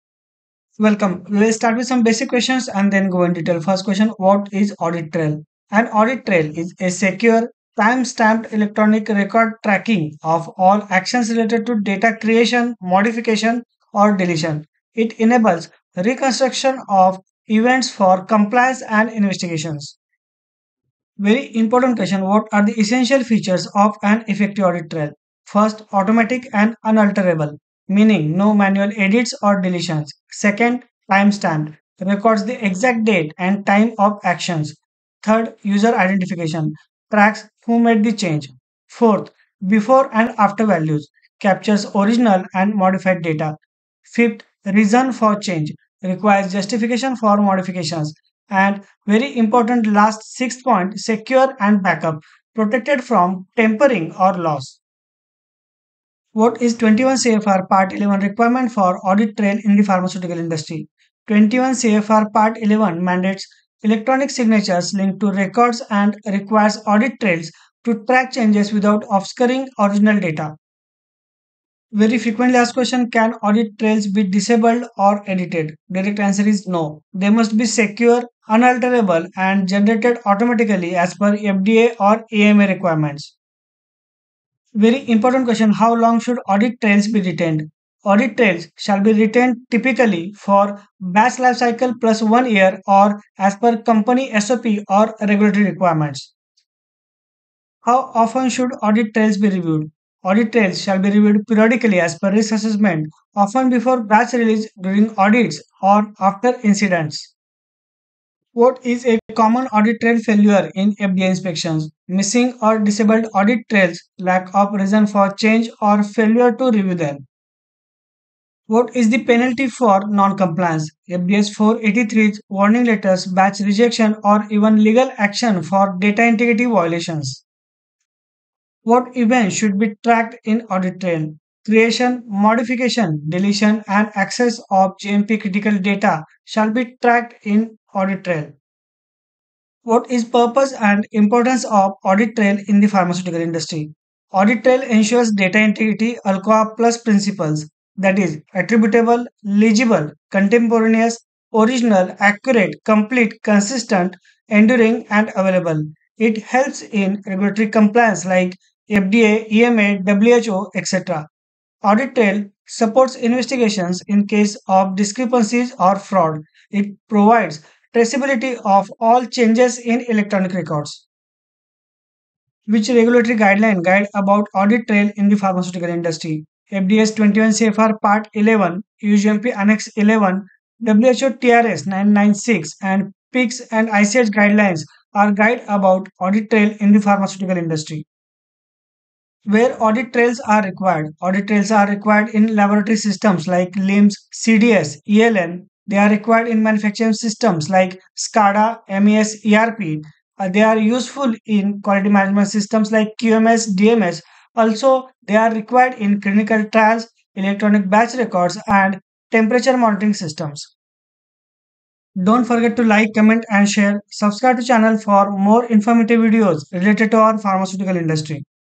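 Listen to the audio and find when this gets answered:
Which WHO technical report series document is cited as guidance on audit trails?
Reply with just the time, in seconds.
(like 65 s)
180 s.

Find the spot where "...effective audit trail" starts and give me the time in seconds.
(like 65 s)
24 s.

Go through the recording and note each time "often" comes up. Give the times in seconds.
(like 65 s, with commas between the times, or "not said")
98 s, 103 s.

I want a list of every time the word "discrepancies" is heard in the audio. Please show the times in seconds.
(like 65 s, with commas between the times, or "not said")
164 s.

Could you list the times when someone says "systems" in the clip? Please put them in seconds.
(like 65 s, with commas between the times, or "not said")
192 s, 197 s, 202 s, 210 s.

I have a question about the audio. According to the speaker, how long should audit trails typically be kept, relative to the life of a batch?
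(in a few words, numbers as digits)
Batch life cycle plus one year.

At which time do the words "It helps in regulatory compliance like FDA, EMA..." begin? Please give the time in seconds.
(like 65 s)
156 s.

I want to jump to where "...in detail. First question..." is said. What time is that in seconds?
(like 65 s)
3 s.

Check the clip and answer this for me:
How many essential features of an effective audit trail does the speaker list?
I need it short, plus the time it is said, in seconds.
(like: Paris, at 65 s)
6, at 50 s.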